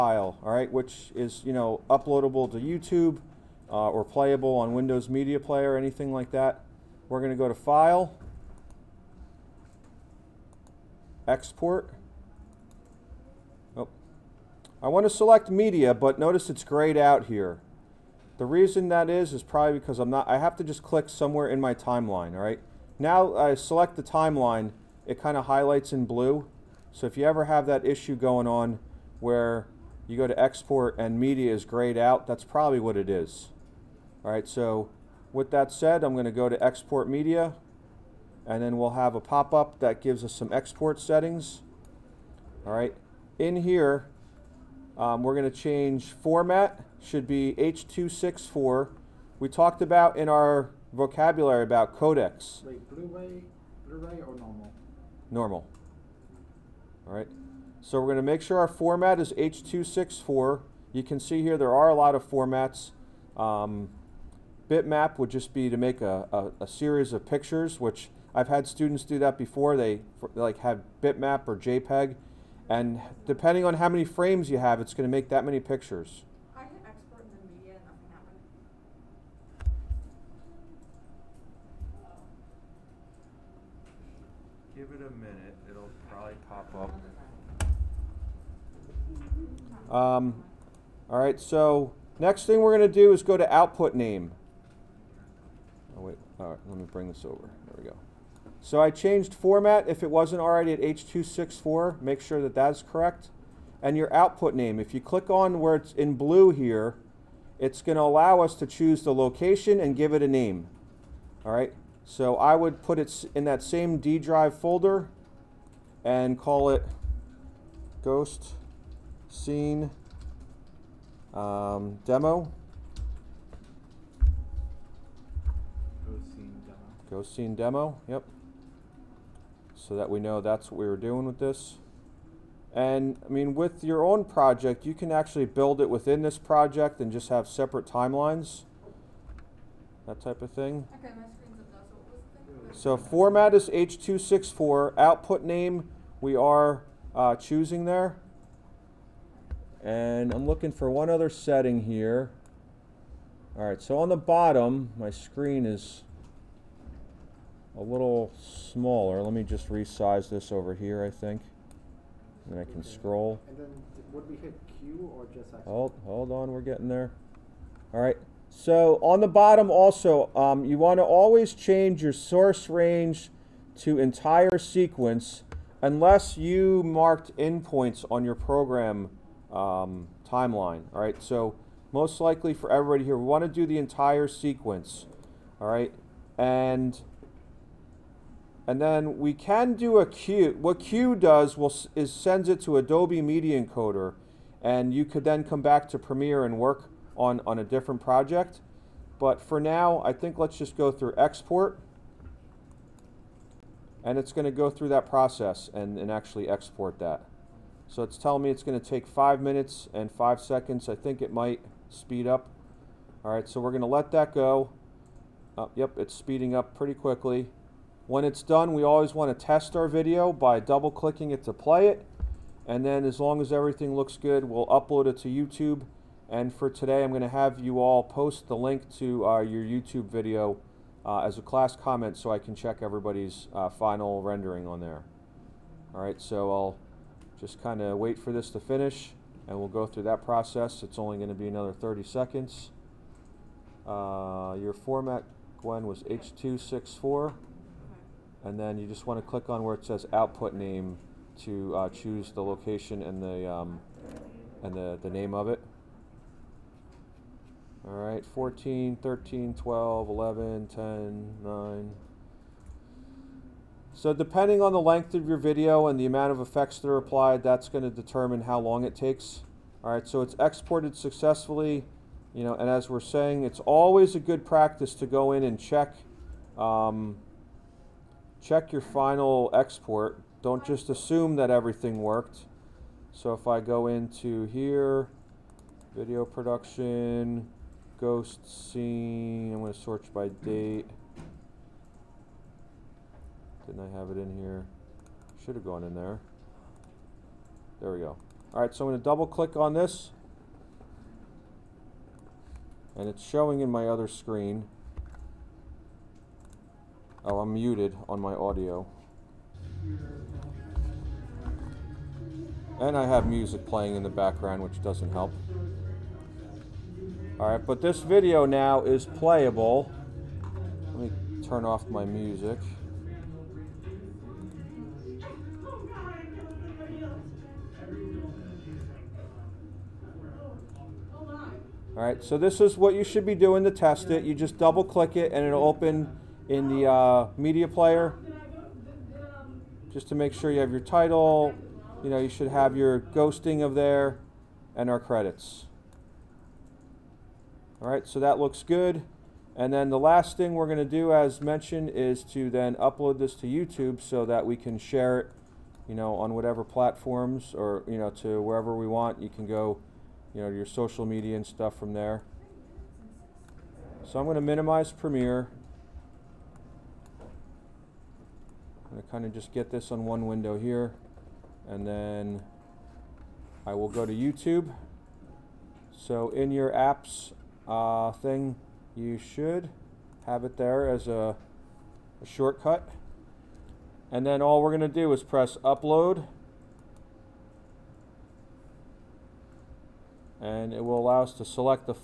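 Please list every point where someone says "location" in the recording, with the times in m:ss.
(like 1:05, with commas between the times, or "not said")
1:49, 4:12.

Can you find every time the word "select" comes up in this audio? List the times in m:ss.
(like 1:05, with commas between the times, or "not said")
0:15, 0:23, 6:31.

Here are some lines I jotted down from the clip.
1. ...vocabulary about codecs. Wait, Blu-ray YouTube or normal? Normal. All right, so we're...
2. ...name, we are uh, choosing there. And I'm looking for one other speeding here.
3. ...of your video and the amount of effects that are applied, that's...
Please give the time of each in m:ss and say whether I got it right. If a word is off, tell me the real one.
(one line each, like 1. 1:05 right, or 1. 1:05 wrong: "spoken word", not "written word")
1. 0:50 wrong: "Blu", not "YouTube"
2. 2:25 wrong: "setting", not "speeding"
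3. 4:25 right.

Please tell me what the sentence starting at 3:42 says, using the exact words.
And then as long as everything looks good, we'll upload it to YouTube.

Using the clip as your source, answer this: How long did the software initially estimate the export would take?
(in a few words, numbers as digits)
5 minutes 5 seconds.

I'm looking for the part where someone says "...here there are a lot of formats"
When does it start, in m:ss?
1:01.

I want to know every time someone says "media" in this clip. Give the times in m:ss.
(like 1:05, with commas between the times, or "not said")
0:05, 0:15, 0:31, 0:37, 1:17, 3:13, 5:37, 6:01.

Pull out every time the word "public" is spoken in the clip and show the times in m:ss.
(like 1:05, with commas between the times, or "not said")
not said.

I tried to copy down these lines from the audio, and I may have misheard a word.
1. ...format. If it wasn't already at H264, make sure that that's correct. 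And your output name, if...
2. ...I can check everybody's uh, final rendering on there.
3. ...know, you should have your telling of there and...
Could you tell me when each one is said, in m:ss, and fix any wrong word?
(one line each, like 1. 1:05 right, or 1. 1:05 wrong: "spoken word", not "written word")
1. 1:39 right
2. 3:52 right
3. 5:42 wrong: "ghosting", not "telling".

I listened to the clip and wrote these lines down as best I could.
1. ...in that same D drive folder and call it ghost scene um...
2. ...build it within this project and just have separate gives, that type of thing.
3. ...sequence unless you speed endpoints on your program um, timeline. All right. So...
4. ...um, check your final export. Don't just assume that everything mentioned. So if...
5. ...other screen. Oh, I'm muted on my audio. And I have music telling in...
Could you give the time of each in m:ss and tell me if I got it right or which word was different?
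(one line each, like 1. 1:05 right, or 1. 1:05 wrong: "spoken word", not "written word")
1. 1:53 right
2. 2:15 wrong: "timelines", not "gives"
3. 2:54 wrong: "marked", not "speed"
4. 4:36 wrong: "worked", not "mentioned"
5. 5:03 wrong: "playing", not "telling".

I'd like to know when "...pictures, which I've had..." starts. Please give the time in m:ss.
1:07.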